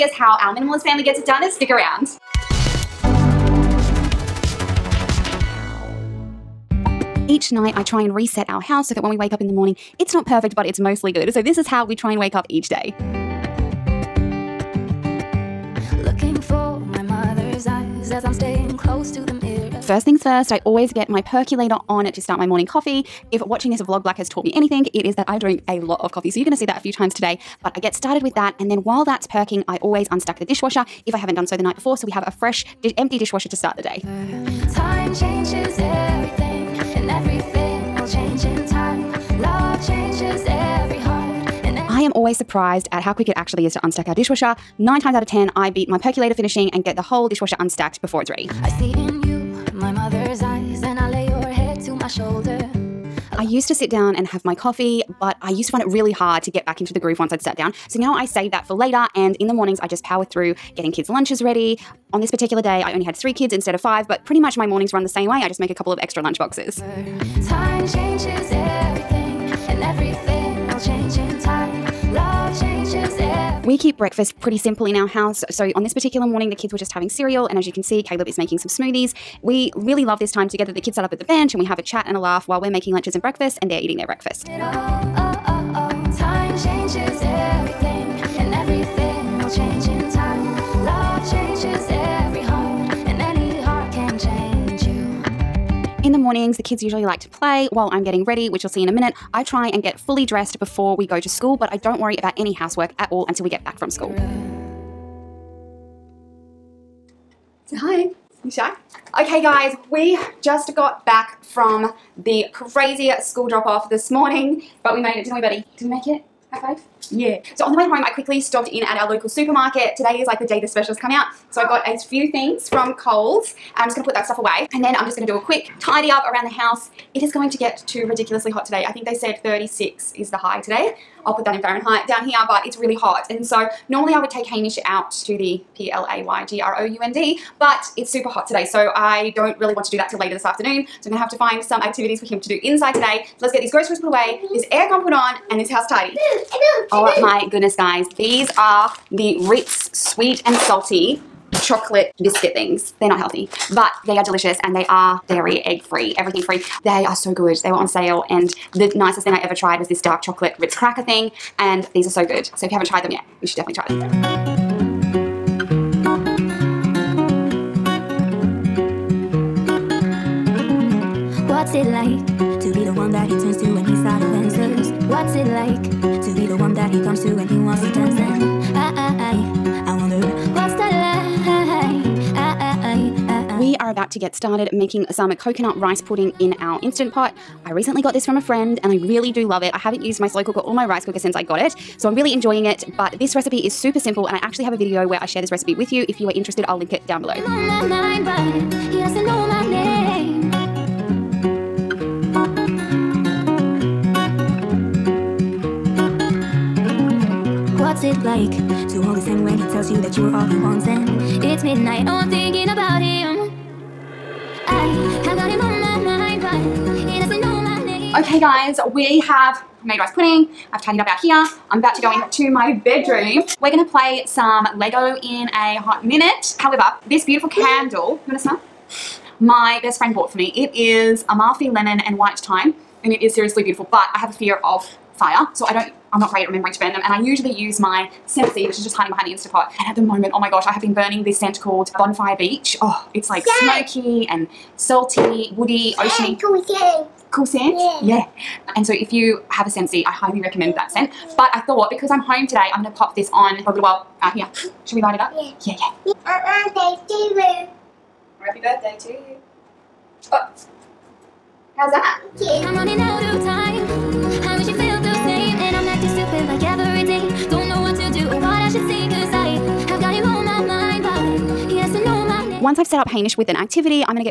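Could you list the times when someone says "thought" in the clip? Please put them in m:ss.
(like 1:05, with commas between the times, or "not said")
4:11.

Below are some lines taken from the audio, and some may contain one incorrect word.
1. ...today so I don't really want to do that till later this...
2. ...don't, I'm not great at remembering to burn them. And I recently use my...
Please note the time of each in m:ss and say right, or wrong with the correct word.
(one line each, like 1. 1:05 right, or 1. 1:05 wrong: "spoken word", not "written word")
1. 2:18 right
2. 3:55 wrong: "usually", not "recently".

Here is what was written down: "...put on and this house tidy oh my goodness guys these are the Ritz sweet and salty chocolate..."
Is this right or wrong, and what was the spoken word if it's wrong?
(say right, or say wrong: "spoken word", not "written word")
right.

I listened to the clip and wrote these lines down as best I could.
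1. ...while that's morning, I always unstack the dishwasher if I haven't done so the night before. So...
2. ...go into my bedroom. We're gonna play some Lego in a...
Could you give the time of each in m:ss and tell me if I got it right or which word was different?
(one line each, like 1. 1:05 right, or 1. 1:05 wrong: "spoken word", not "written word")
1. 0:28 wrong: "perking", not "morning"
2. 3:42 right.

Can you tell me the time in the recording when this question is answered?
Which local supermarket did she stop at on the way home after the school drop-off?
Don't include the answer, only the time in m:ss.
2:02.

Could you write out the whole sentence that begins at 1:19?
We really love this time together.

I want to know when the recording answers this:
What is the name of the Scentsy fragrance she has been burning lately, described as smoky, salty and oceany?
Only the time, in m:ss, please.
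4:01.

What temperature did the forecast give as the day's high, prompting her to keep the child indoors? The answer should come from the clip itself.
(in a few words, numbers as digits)
36.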